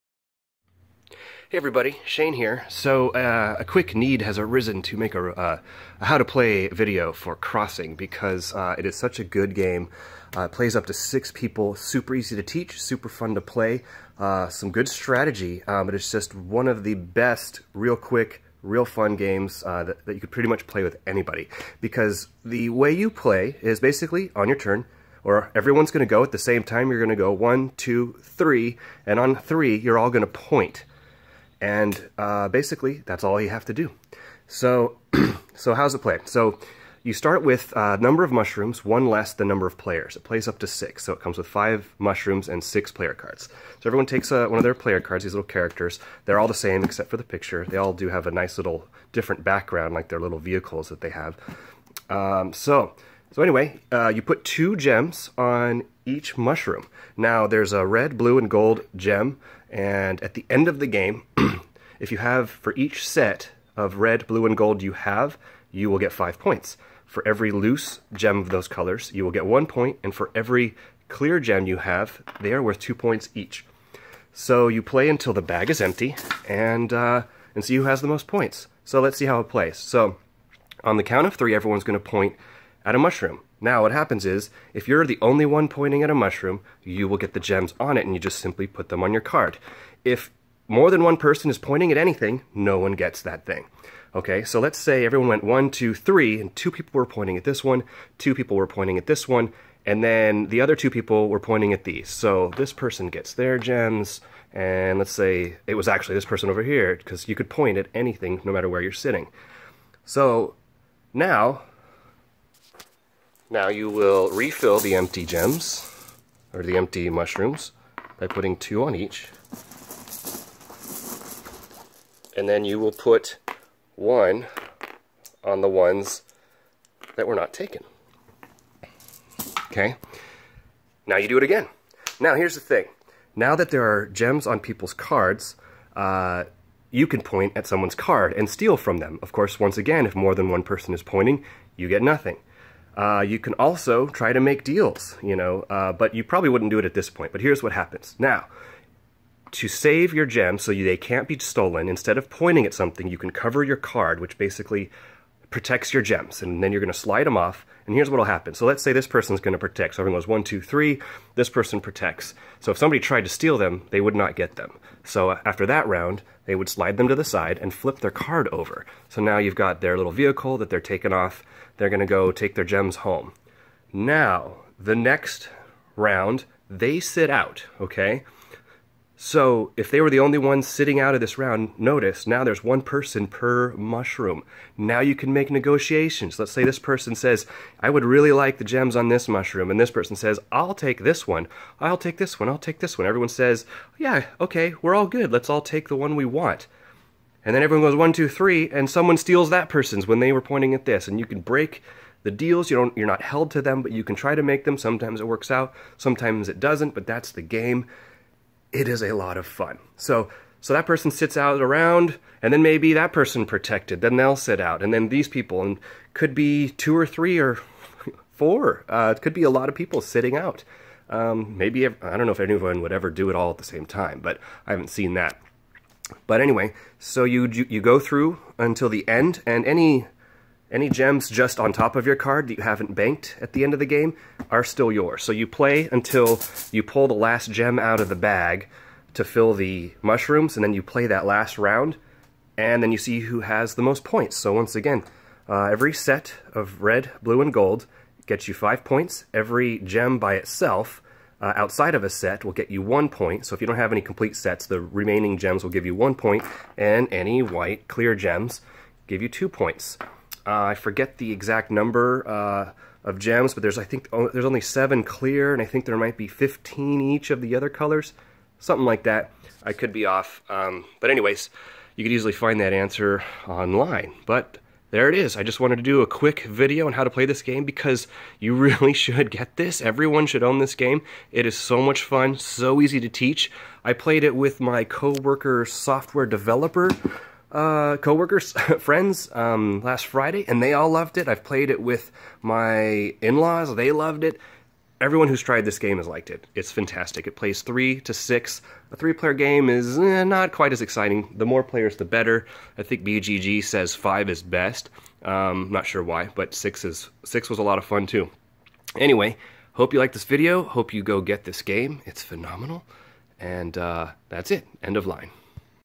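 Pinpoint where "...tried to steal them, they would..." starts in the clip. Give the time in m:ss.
2:42.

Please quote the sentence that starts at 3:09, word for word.
And this person says, I'll take this one.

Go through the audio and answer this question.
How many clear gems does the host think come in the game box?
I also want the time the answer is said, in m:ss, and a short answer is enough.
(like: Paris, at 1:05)
7, at 4:24.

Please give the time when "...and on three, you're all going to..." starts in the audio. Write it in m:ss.
0:29.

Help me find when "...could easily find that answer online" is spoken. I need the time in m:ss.
4:32.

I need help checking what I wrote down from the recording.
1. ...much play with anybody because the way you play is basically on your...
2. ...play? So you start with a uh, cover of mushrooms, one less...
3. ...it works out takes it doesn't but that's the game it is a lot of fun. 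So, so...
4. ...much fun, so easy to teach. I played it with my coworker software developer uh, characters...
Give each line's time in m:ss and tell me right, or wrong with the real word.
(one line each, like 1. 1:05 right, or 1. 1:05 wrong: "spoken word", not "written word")
1. 0:20 right
2. 0:36 wrong: "number", not "cover"
3. 3:25 wrong: "sometimes", not "takes"
4. 4:41 wrong: "coworkers", not "characters".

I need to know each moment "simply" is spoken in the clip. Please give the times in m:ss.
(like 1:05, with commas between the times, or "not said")
1:28.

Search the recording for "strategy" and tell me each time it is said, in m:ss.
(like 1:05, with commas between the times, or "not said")
0:14.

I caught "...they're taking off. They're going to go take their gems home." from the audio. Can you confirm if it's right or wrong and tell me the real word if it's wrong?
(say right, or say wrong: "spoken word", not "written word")
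right.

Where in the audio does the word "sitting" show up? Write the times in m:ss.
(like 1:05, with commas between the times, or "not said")
1:48, 3:00, 3:40.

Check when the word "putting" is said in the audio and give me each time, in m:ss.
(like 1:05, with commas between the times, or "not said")
1:58.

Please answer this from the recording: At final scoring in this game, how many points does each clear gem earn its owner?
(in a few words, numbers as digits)
2.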